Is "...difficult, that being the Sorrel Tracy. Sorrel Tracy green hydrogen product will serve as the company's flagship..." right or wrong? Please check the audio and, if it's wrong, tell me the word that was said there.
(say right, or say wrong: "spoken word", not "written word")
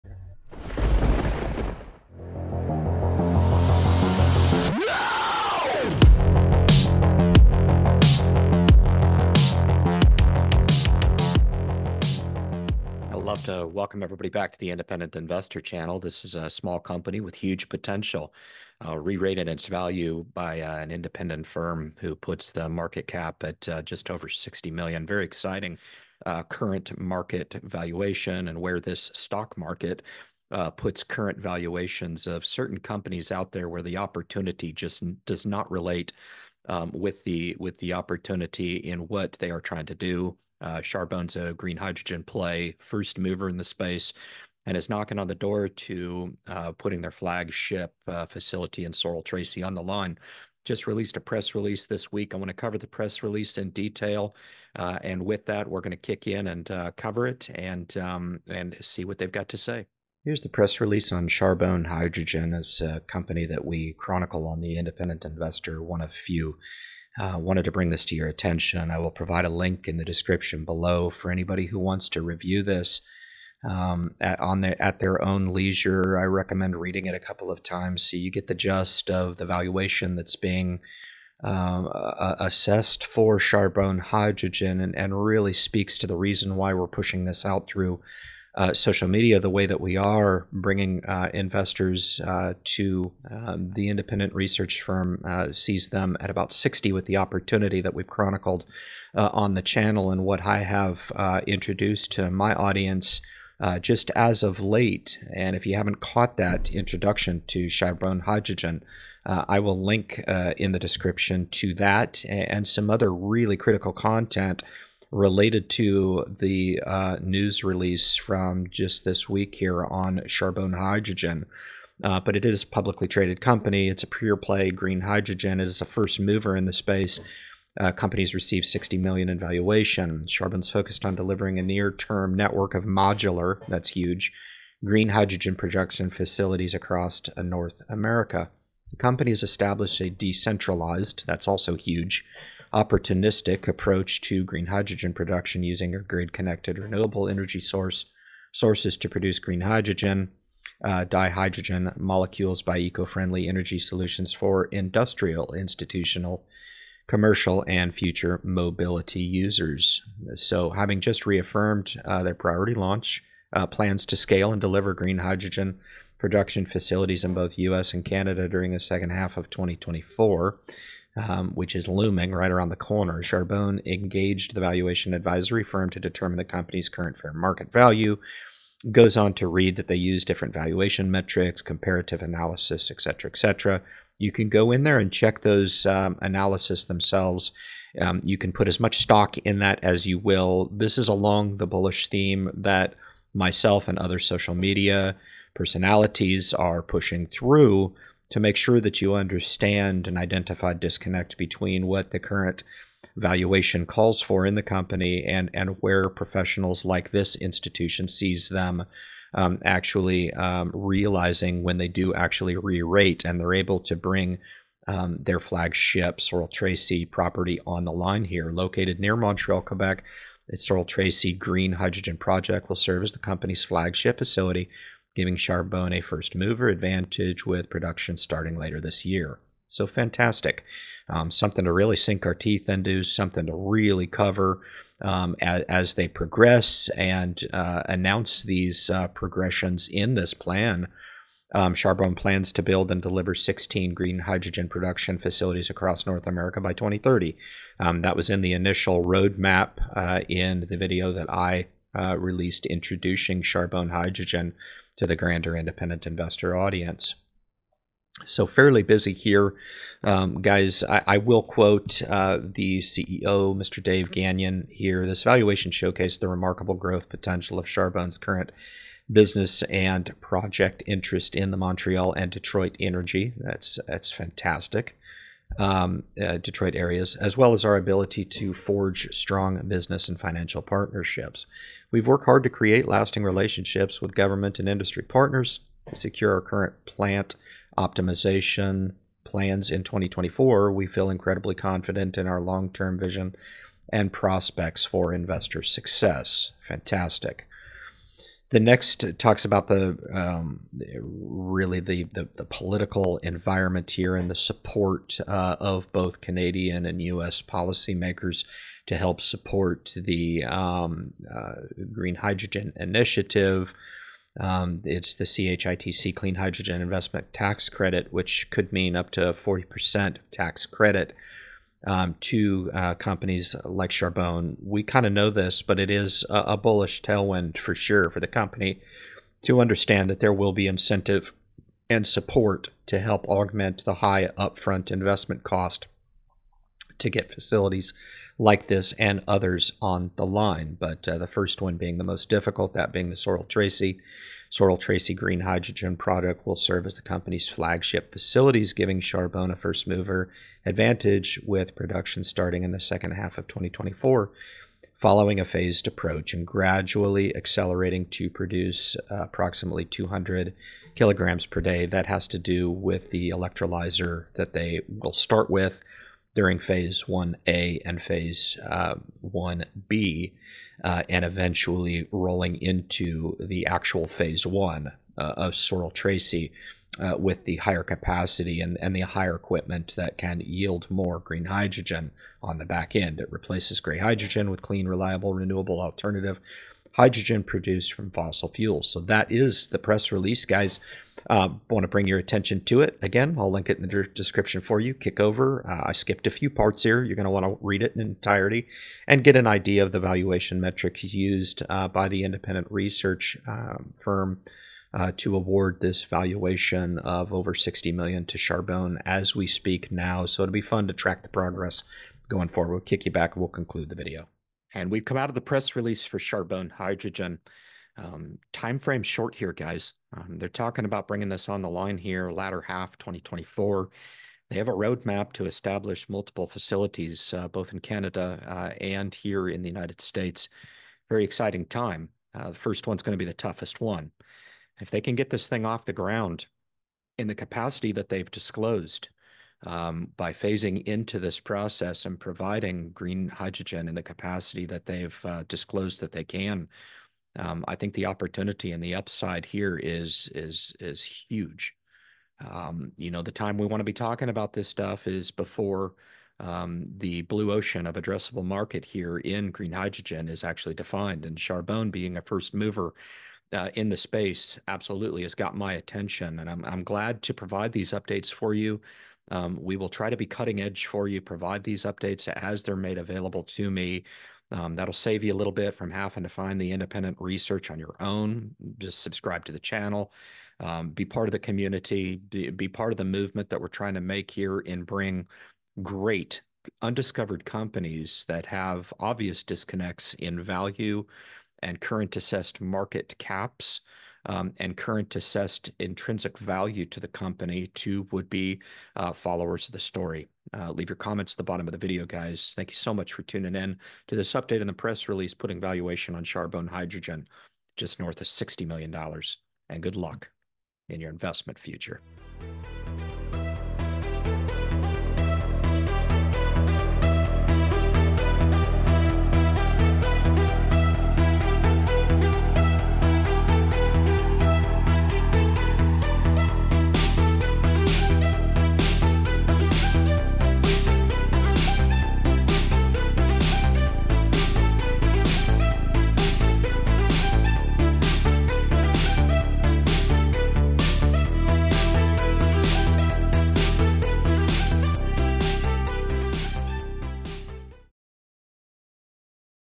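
right.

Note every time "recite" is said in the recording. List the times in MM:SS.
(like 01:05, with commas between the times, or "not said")
not said.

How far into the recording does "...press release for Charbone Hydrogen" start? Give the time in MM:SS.
06:55.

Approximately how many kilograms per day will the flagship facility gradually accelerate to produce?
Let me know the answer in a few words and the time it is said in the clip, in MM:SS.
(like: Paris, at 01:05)
200, at 05:59.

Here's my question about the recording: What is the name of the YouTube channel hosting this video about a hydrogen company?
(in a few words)
Independent Investor Channel.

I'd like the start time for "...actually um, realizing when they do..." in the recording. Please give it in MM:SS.
03:29.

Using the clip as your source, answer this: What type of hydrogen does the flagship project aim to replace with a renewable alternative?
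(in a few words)
gray hydrogen.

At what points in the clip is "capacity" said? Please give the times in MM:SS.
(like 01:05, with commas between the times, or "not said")
06:17, 07:17, 07:24.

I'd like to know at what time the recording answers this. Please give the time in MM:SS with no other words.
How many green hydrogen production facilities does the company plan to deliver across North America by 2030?
04:03.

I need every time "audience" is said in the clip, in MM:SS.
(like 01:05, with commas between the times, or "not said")
01:42, 04:16.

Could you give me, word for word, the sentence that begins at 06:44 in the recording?
Uh, to award this valuation of over 60 million to Charbone as we speak now.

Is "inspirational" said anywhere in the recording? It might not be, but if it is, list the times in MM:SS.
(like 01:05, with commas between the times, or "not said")
not said.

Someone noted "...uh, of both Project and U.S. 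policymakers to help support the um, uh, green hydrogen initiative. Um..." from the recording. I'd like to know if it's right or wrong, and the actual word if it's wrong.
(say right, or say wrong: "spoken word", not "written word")
wrong: "Canadian", not "Project".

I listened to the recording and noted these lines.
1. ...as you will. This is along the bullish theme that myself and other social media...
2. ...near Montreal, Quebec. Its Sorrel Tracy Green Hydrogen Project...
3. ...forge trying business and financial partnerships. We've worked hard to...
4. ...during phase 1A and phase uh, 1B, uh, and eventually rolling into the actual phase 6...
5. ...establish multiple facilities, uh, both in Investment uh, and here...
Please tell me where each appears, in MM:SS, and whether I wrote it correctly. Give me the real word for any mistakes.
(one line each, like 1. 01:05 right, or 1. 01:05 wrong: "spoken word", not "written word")
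1. 03:09 right
2. 03:38 right
3. 04:38 wrong: "strong", not "trying"
4. 06:06 wrong: "1", not "6"
5. 07:05 wrong: "Canada", not "Investment".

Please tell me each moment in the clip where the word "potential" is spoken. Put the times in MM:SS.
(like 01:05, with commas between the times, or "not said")
00:17, 04:27.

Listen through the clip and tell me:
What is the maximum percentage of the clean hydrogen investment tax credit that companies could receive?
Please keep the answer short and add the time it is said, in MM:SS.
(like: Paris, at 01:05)
40%, at 05:19.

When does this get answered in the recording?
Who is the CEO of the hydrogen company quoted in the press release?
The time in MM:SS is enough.
04:23.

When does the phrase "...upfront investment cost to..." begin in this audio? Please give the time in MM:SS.
05:34.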